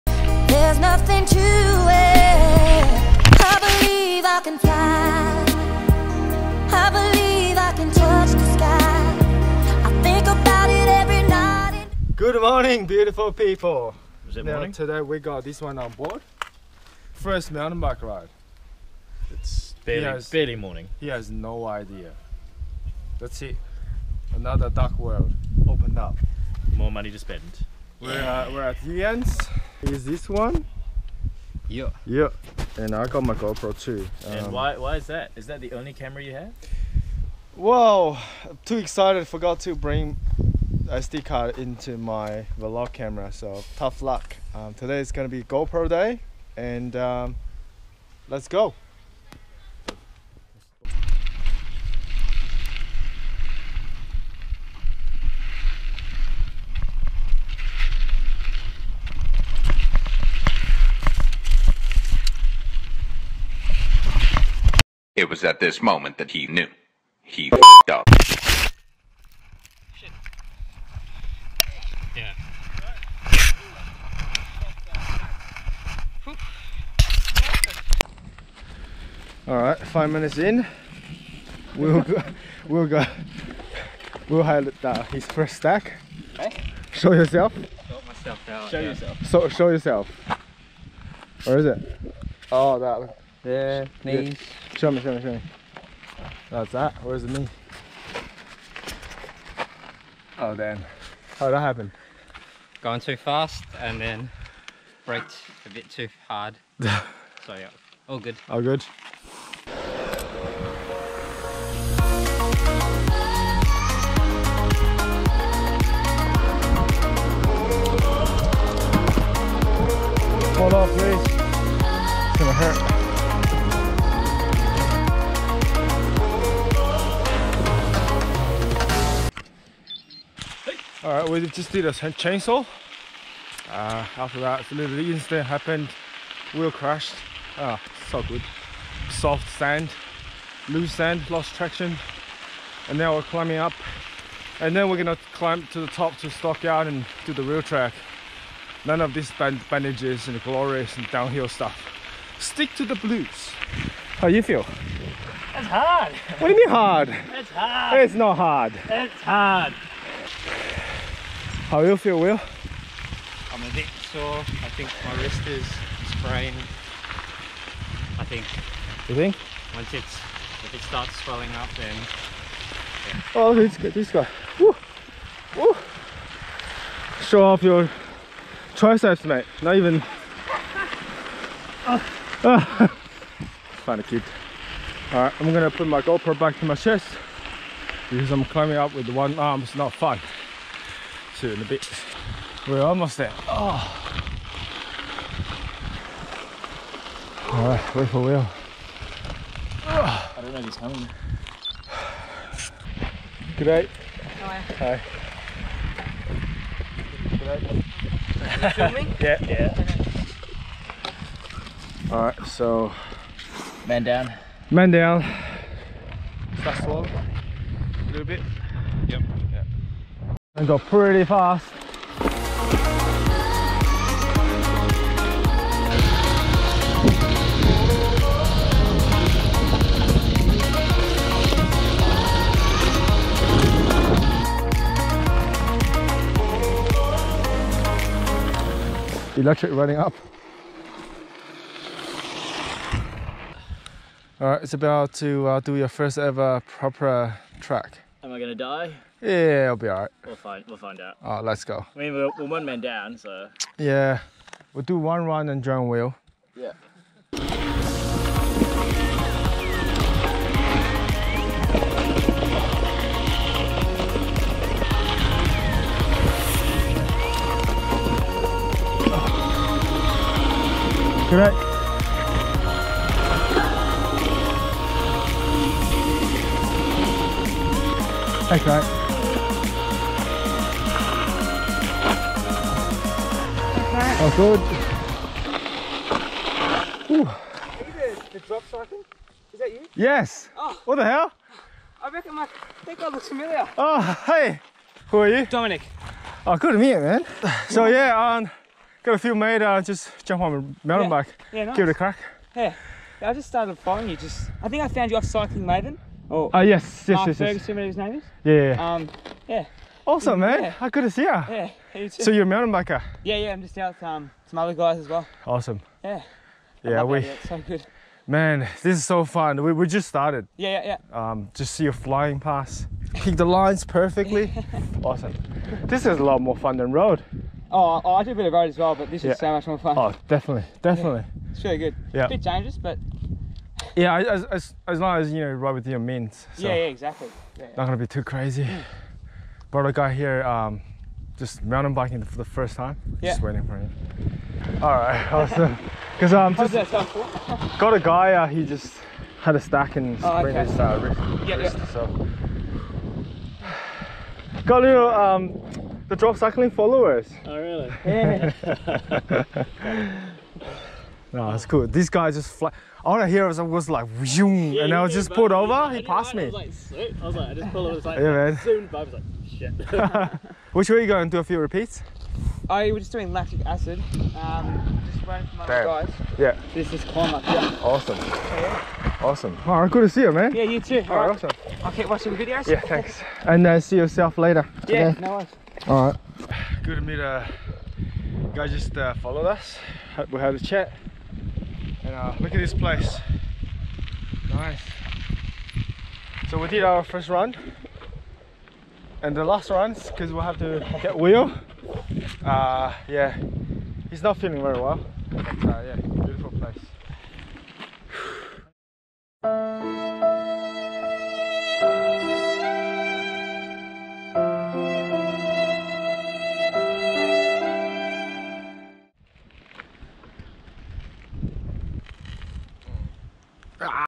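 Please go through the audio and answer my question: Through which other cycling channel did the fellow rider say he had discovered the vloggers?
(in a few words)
Cycling Maven.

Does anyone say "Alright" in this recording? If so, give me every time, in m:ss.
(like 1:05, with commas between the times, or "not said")
3:05, 3:17.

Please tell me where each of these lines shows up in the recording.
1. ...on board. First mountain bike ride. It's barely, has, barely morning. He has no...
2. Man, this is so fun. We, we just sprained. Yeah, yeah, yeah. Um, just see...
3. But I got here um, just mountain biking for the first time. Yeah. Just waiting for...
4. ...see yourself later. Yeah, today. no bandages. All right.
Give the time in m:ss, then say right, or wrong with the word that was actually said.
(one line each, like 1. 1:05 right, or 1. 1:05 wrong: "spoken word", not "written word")
1. 0:15 right
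2. 5:18 wrong: "started", not "sprained"
3. 5:39 right
4. 6:23 wrong: "worries", not "bandages".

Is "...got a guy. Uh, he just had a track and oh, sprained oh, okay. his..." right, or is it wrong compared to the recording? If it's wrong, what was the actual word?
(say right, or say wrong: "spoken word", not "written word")
wrong: "stack", not "track".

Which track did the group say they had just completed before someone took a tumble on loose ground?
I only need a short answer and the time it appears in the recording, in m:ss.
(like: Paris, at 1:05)
Chainsaw, at 2:11.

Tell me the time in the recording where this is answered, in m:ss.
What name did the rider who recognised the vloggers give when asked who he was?
4:55.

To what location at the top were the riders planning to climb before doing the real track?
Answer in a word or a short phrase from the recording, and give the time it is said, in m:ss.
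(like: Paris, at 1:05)
Stockyard, at 2:26.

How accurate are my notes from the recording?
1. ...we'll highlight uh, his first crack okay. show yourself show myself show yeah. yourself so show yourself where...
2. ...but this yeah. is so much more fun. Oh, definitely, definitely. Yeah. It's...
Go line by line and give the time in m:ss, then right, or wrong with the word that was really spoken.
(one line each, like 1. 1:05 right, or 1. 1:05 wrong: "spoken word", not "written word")
1. 1:24 wrong: "stack", not "crack"
2. 5:28 right.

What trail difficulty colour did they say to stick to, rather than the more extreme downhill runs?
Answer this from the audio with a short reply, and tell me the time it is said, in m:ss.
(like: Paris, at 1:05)
Blues, at 2:32.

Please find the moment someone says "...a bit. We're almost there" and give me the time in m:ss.
3:11.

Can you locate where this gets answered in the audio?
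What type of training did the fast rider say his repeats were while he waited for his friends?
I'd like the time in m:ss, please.
6:13.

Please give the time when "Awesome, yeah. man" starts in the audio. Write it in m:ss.
5:10.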